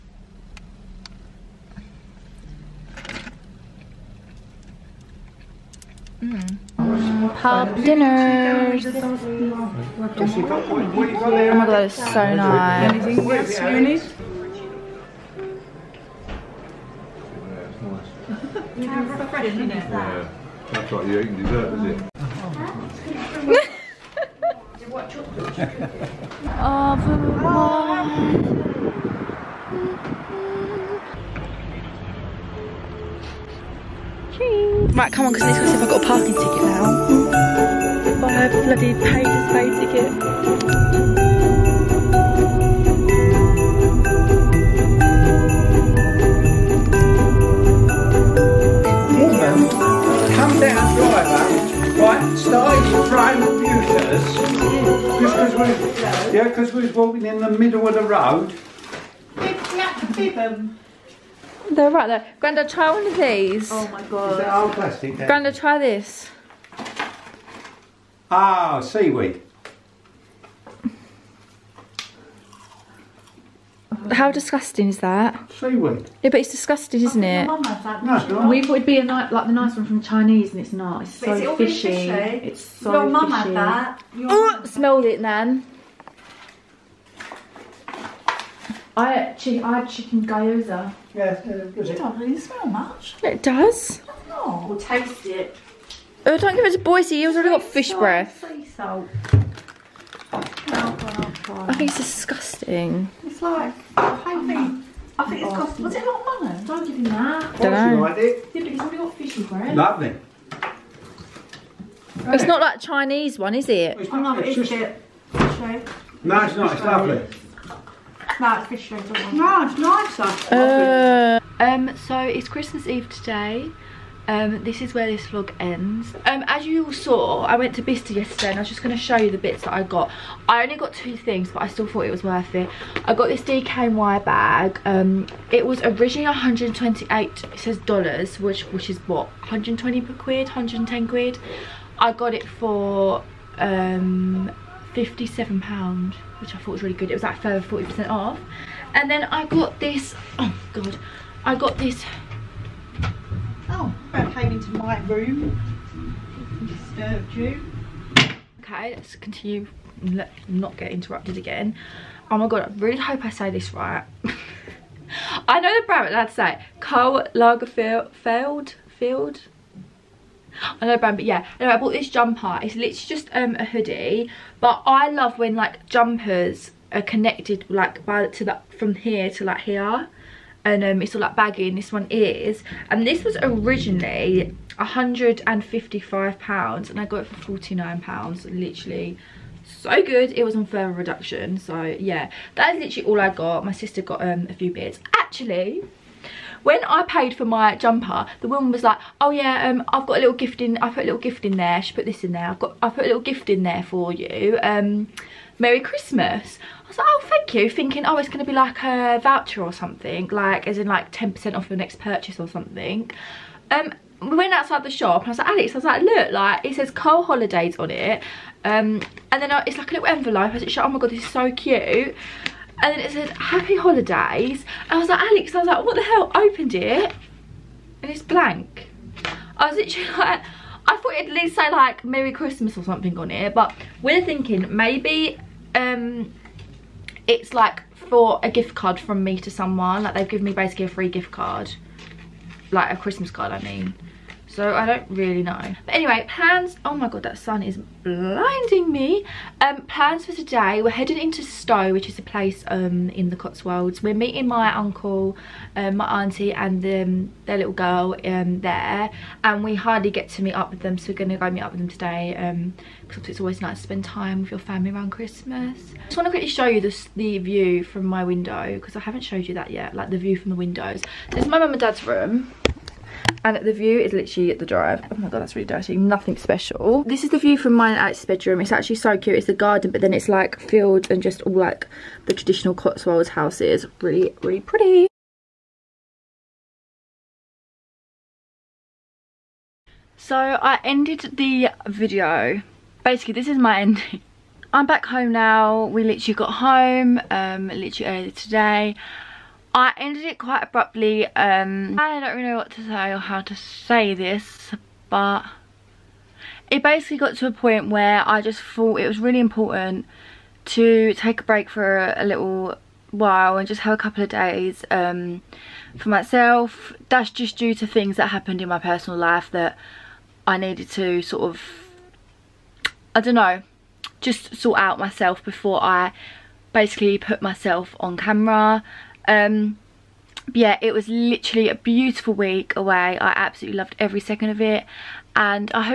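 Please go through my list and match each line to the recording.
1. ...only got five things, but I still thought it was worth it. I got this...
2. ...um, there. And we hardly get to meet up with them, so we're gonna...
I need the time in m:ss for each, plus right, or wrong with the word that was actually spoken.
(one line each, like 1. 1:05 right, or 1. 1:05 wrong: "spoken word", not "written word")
1. 2:10 wrong: "two", not "five"
2. 4:18 right.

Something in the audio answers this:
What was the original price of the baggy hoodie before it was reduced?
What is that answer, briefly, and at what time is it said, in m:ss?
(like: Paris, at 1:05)
155 pounds, at 3:04.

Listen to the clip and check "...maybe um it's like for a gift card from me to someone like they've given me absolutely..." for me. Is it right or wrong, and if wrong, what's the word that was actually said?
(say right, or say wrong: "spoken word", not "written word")
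wrong: "basically", not "absolutely".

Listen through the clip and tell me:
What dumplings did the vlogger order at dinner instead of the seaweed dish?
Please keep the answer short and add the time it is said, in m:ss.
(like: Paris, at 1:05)
Chicken gyoza, at 1:29.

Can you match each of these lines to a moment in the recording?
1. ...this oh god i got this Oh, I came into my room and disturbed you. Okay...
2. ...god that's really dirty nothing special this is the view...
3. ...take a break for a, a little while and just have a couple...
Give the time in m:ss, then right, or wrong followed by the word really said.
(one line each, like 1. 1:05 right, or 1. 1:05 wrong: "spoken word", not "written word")
1. 2:29 right
2. 4:35 right
3. 5:11 right.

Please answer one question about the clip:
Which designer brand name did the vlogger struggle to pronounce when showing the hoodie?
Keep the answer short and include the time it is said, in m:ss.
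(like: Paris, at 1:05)
Karl Lagerfeld, at 2:46.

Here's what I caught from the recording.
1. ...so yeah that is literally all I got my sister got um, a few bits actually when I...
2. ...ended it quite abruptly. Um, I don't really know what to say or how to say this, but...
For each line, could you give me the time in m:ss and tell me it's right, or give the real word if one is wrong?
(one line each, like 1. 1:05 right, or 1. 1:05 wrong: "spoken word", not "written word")
1. 3:11 right
2. 4:59 right.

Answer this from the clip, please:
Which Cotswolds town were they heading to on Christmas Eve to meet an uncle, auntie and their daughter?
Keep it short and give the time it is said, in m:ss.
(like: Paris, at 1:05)
Stow, at 4:11.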